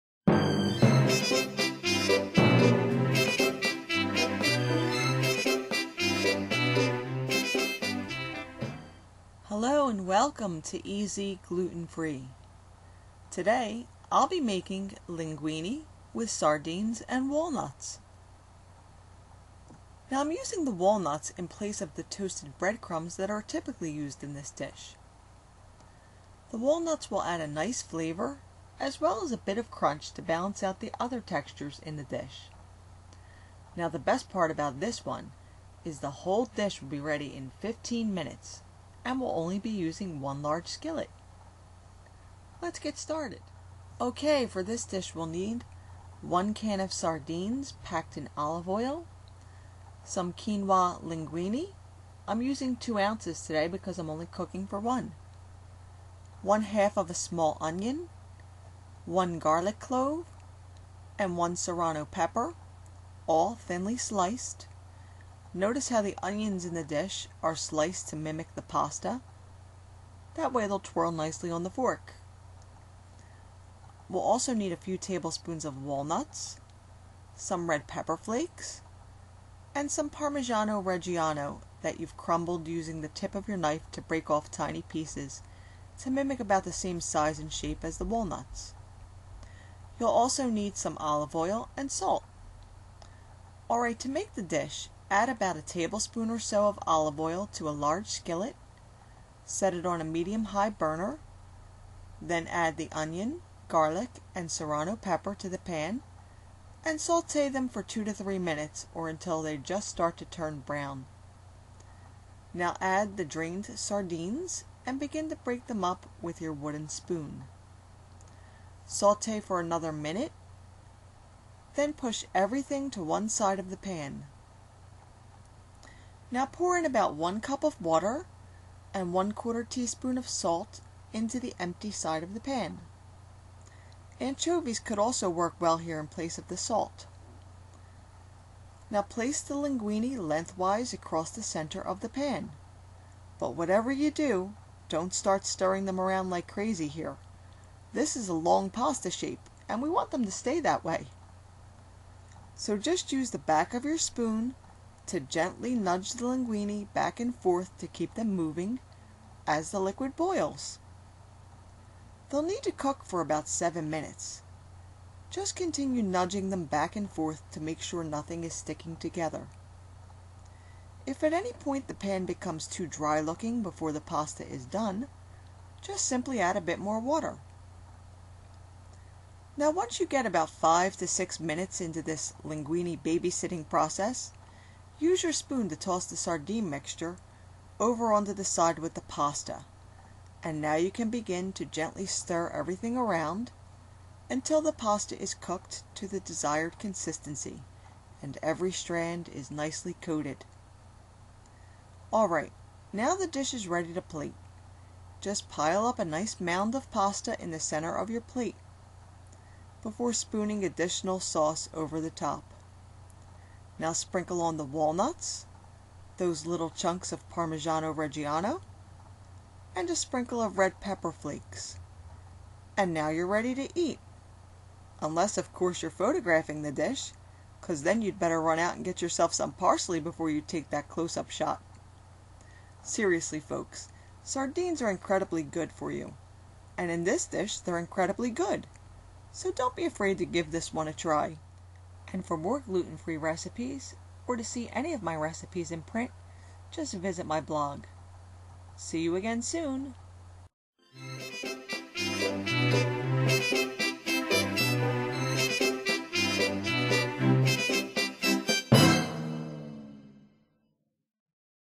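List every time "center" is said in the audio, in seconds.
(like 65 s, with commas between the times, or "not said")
141 s, 207 s.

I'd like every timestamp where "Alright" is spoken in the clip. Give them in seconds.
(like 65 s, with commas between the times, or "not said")
93 s, 202 s.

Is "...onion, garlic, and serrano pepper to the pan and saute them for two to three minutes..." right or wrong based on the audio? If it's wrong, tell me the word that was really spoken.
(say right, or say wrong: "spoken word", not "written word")
right.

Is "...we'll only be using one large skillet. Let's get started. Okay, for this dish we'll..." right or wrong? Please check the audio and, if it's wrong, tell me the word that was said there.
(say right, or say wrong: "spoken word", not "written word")
right.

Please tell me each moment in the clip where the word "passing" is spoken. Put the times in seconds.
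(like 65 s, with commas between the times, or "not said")
not said.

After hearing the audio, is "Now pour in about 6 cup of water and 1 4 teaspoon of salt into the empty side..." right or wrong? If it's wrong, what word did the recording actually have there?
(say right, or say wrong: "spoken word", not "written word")
wrong: "1", not "6".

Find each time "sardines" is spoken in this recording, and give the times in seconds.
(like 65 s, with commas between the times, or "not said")
16 s, 46 s, 113 s, 186 s, 234 s.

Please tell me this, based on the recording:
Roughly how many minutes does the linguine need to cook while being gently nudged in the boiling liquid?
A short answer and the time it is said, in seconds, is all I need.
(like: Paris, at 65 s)
7 minutes, at 163 s.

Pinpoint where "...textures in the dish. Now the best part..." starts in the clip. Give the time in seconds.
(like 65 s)
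31 s.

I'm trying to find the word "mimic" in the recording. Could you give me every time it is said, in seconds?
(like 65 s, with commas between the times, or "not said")
68 s, 86 s.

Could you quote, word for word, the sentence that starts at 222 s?
And now you're ready to eat.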